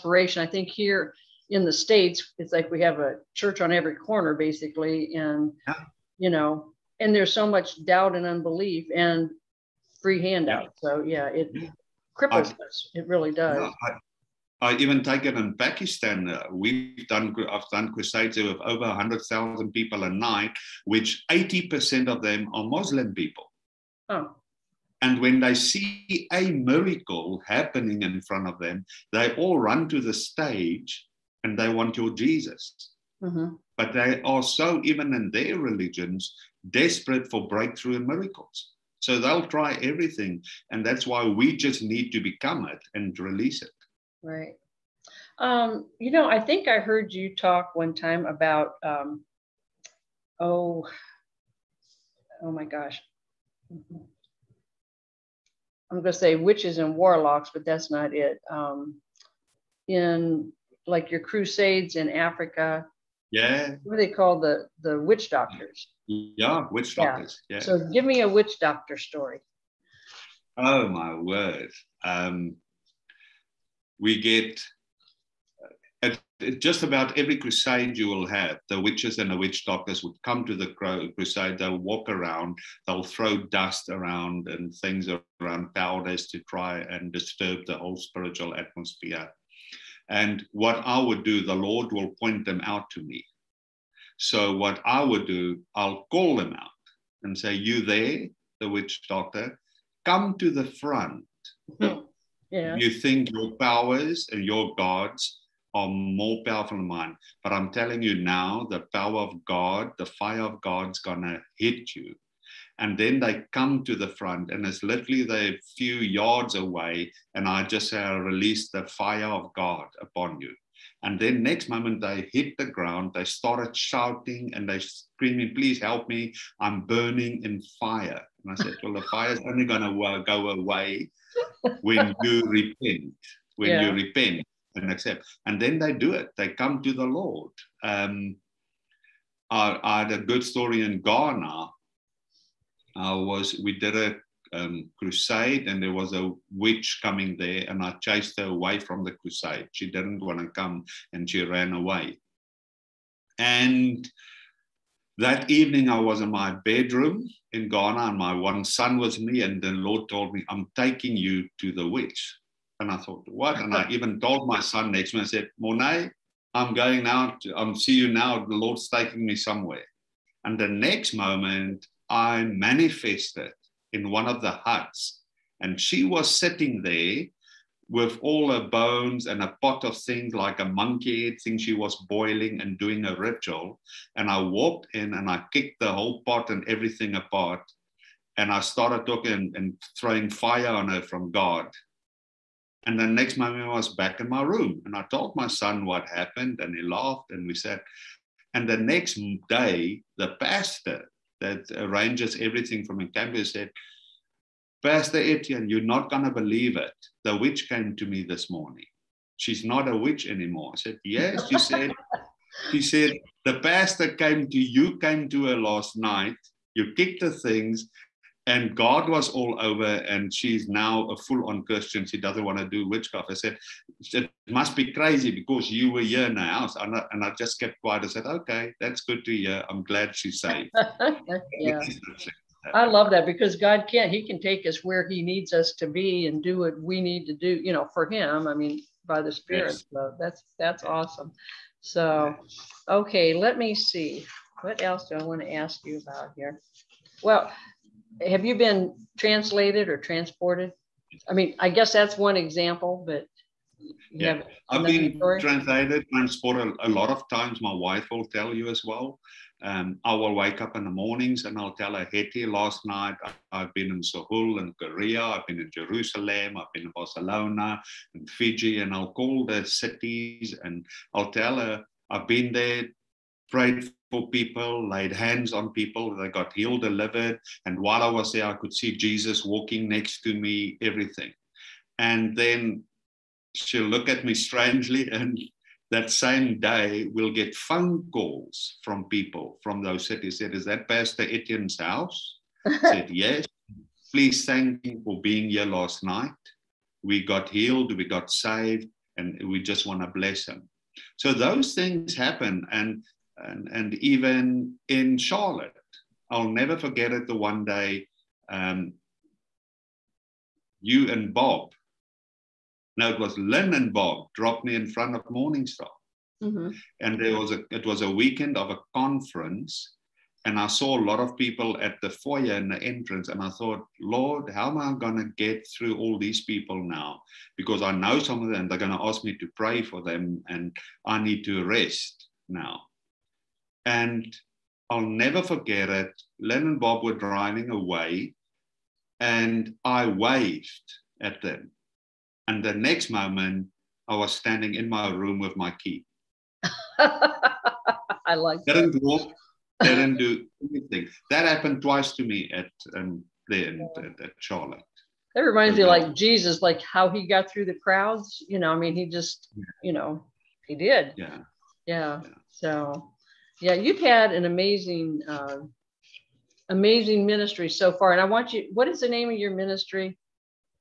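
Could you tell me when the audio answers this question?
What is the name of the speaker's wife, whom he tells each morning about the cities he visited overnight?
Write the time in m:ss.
4:22.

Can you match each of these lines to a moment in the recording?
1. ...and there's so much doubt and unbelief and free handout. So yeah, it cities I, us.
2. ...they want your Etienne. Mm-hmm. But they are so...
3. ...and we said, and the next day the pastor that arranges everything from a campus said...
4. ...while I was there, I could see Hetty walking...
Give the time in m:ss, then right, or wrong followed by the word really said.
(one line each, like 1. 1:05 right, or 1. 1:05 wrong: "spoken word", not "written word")
1. 0:06 wrong: "cripples", not "cities"
2. 0:31 wrong: "Jesus", not "Etienne"
3. 3:17 right
4. 4:37 wrong: "Jesus", not "Hetty".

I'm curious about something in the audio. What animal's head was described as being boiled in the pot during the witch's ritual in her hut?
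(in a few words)
monkey.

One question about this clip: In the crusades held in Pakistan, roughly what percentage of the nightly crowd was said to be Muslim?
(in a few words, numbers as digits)
80%.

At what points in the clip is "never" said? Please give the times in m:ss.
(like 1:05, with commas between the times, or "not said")
5:06, 5:35.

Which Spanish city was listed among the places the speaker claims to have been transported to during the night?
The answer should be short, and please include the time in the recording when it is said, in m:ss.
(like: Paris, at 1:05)
Barcelona, at 4:26.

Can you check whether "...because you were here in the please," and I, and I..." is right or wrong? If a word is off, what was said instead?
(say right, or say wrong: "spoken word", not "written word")
wrong: "house", not "please".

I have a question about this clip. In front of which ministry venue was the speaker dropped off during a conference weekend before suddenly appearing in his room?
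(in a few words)
Morningstar.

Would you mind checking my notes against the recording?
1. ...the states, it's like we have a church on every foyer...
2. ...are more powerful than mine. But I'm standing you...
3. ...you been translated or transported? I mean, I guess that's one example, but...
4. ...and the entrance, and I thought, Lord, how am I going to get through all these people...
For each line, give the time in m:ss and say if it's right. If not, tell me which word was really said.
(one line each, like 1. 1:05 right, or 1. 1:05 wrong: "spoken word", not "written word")
1. 0:01 wrong: "corner", not "foyer"
2. 1:45 wrong: "telling", not "standing"
3. 4:08 right
4. 5:22 right.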